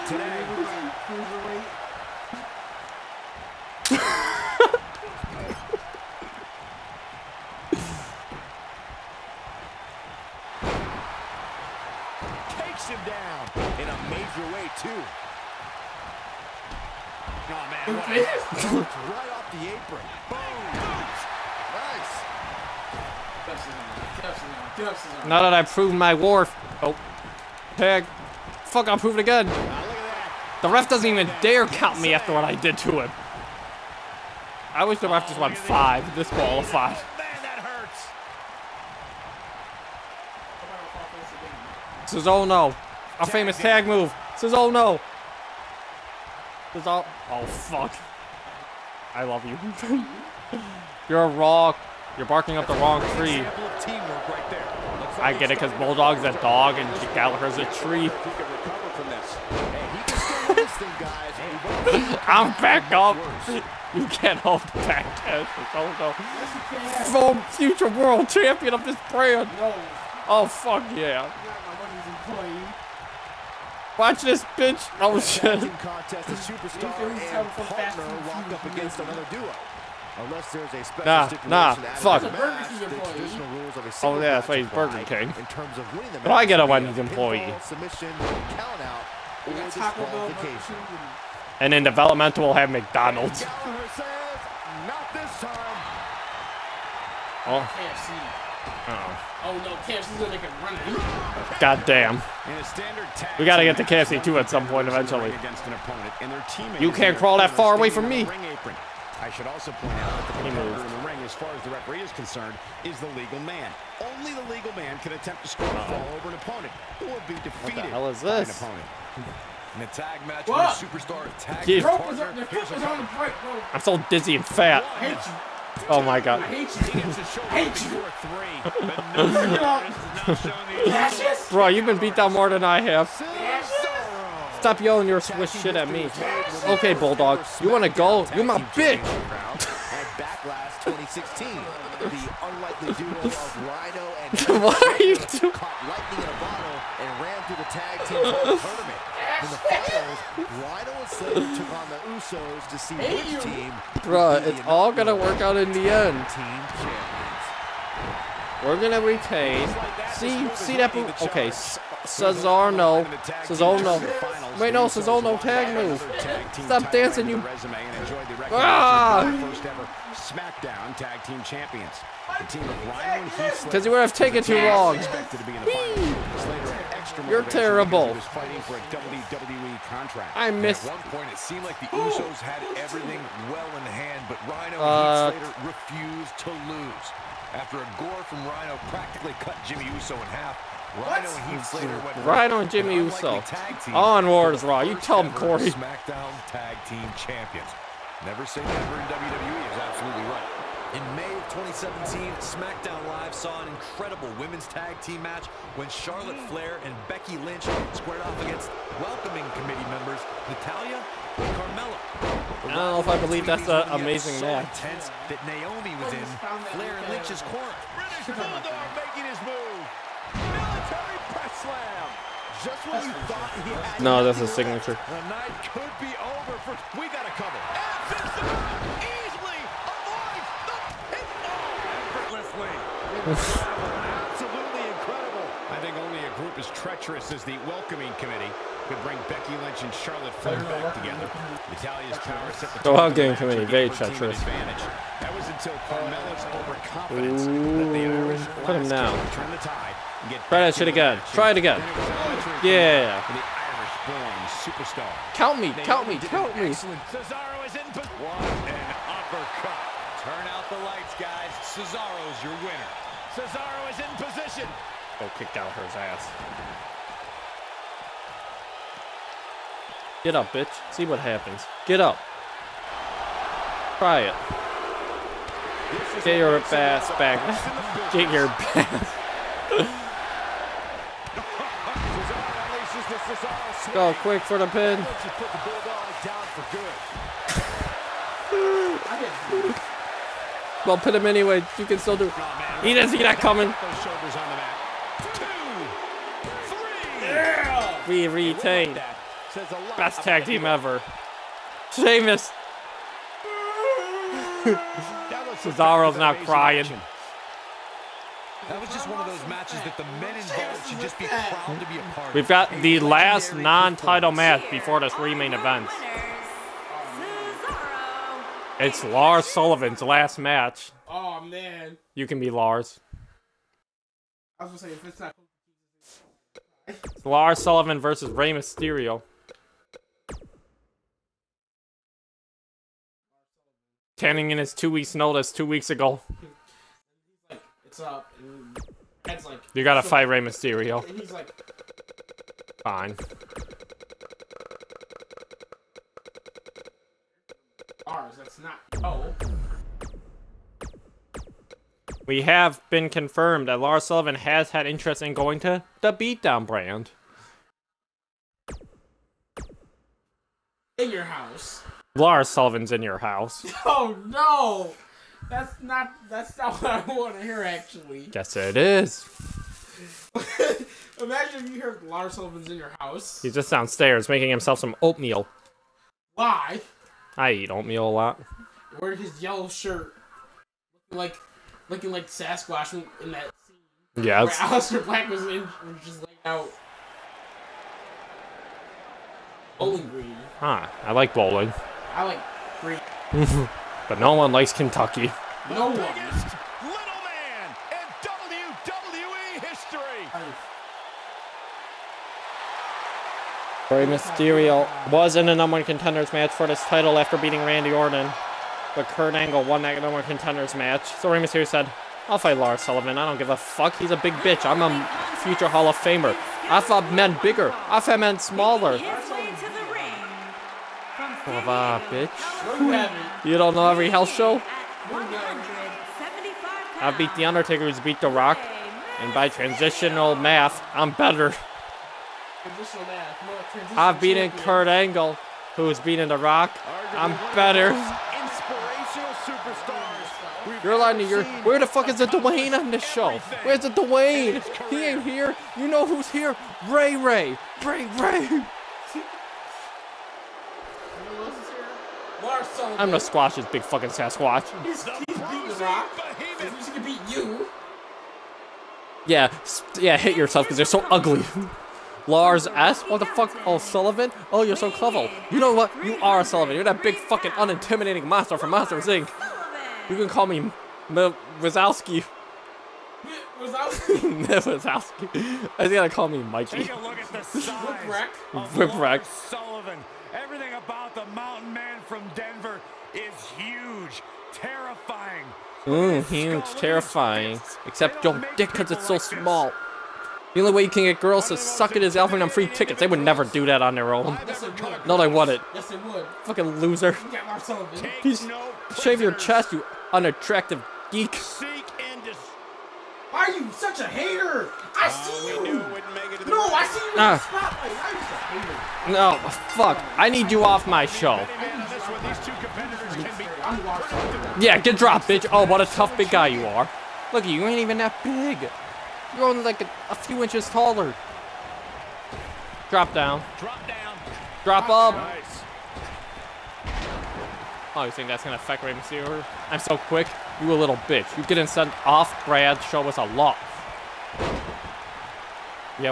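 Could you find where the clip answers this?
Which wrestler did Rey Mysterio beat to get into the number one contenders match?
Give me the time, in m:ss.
6:47.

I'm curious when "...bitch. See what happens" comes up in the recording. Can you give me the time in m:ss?
4:30.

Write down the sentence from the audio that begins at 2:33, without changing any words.
Bruh, it's all gonna work out in the end.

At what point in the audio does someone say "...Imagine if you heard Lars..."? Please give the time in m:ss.
6:11.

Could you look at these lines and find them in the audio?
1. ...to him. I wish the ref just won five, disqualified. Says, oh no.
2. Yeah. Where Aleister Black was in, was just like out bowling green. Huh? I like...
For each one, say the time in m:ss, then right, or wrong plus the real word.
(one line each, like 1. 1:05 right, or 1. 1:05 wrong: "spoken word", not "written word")
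1. 0:32 right
2. 6:24 right.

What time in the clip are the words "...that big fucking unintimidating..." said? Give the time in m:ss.
7:46.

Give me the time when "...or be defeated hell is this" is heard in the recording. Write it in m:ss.
1:56.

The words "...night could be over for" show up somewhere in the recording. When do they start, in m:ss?
3:45.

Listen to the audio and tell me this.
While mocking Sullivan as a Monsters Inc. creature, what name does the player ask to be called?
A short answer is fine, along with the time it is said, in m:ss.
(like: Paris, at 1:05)
M Wazowski, at 7:50.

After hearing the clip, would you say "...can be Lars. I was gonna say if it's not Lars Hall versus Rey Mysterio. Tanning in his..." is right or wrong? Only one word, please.
wrong.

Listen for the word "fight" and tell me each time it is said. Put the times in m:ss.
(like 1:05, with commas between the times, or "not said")
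5:40, 6:52.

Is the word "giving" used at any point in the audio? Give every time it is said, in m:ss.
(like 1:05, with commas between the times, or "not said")
not said.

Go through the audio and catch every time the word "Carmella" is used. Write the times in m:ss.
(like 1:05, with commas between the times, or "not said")
3:31, 4:05.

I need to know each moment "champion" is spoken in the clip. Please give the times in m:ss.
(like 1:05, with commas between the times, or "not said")
1:08, 2:36, 3:17.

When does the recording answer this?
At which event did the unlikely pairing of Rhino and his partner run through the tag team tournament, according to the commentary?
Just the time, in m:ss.
2:20.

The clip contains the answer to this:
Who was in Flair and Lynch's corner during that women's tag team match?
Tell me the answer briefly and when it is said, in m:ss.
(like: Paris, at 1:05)
Naomi, at 3:35.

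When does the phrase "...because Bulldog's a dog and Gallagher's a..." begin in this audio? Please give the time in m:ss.
0:55.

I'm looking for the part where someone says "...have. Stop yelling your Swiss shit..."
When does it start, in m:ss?
2:12.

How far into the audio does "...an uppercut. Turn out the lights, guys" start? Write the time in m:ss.
4:18.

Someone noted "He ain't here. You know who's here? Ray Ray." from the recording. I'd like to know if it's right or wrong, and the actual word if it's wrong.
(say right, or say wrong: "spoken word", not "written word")
right.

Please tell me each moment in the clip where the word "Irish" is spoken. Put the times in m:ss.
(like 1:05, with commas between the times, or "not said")
4:13.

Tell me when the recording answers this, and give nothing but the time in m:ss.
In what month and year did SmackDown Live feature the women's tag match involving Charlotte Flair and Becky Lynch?
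3:21.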